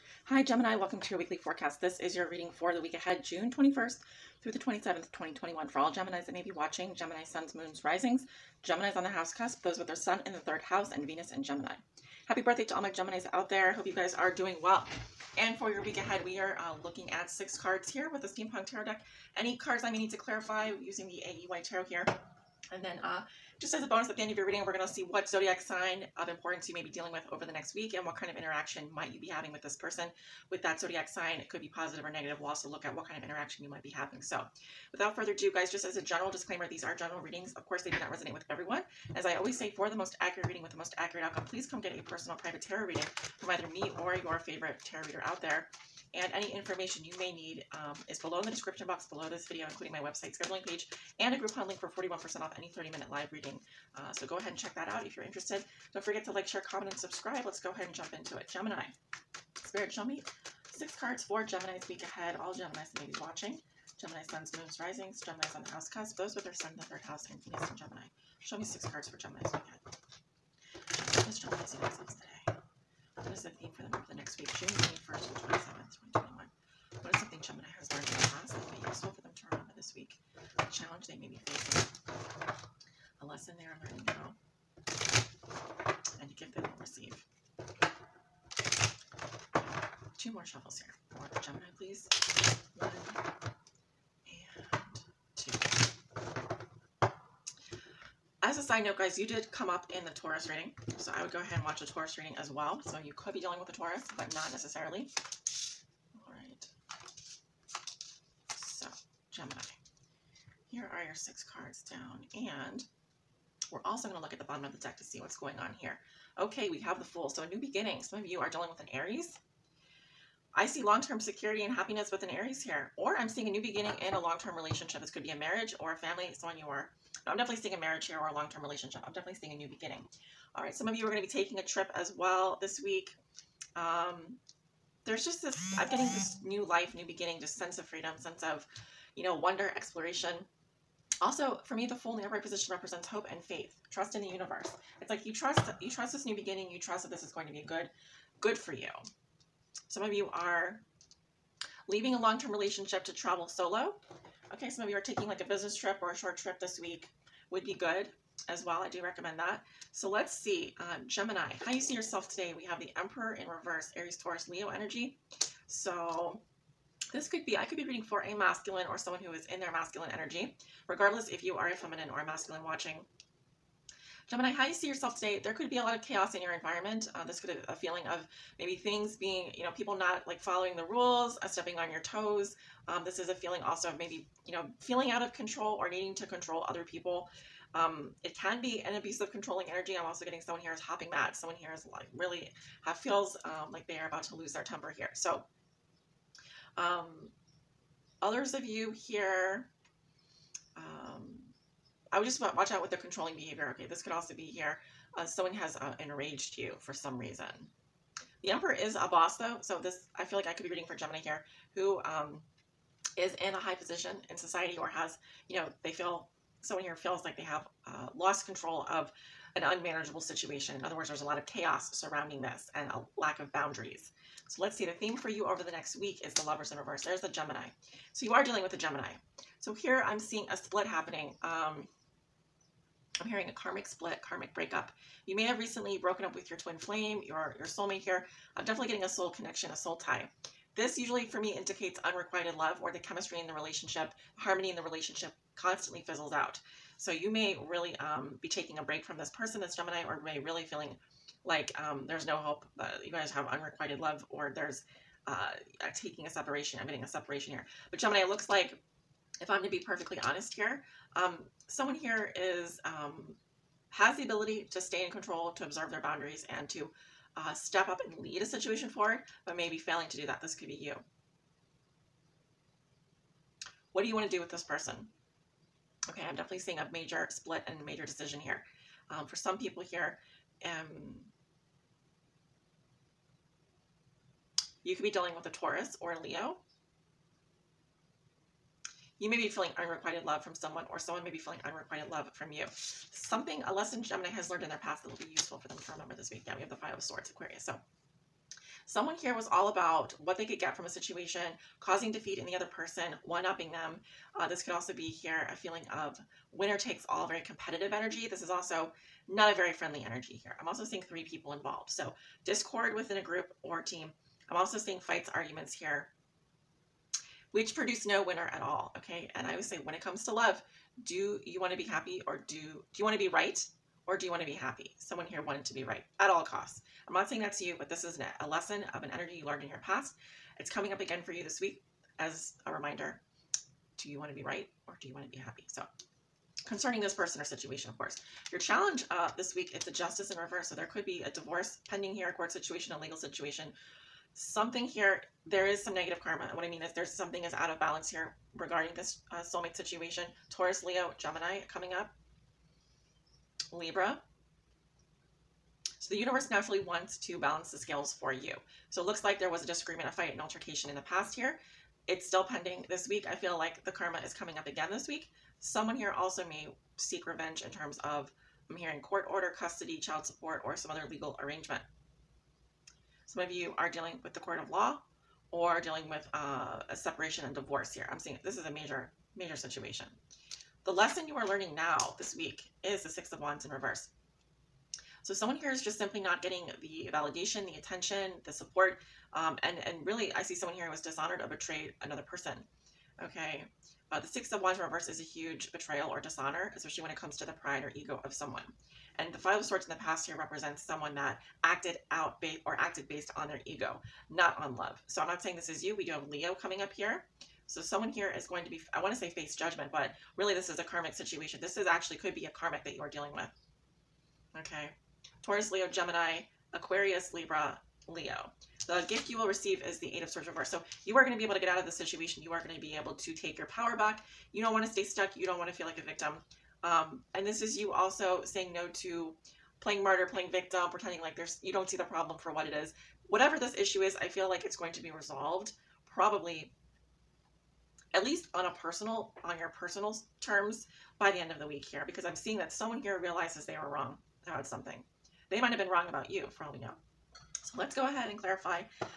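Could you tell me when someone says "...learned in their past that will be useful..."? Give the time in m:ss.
4:54.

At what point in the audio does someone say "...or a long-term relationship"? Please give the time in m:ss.
2:08.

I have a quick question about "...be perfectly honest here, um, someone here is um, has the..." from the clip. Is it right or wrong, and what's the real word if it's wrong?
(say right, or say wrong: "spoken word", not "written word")
right.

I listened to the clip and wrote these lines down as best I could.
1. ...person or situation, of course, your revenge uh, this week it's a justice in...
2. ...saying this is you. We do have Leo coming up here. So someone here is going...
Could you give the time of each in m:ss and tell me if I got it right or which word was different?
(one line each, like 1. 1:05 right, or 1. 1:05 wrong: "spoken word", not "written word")
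1. 5:37 wrong: "challenge", not "revenge"
2. 6:45 right.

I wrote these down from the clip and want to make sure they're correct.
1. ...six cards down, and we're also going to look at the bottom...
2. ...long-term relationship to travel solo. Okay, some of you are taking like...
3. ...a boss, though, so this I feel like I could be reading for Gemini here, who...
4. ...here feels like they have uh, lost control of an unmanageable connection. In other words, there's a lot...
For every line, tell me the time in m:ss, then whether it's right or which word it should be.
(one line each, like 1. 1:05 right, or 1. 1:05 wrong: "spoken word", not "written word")
1. 1:51 right
2. 2:32 right
3. 3:28 right
4. 3:36 wrong: "situation", not "connection".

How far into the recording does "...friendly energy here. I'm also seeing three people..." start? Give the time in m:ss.
5:09.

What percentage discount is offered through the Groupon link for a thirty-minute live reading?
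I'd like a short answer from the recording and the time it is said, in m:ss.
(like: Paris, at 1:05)
41%, at 0:51.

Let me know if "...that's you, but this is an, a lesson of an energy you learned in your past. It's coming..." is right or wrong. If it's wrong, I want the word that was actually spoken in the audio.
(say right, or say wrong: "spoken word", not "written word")
right.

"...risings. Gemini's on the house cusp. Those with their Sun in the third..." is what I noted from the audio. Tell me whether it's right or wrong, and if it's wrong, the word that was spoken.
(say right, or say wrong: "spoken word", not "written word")
right.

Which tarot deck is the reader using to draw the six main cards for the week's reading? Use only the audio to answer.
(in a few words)
Steampunk Tarot.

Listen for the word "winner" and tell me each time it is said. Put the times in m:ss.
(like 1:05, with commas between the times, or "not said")
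5:06, 5:18.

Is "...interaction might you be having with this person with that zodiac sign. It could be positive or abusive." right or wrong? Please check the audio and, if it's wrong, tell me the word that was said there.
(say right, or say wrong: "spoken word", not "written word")
wrong: "negative", not "abusive".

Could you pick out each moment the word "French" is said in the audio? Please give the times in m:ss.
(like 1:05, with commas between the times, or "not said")
not said.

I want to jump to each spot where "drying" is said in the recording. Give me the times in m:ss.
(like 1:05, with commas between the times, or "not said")
not said.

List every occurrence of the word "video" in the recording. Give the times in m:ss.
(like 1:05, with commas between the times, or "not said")
0:49.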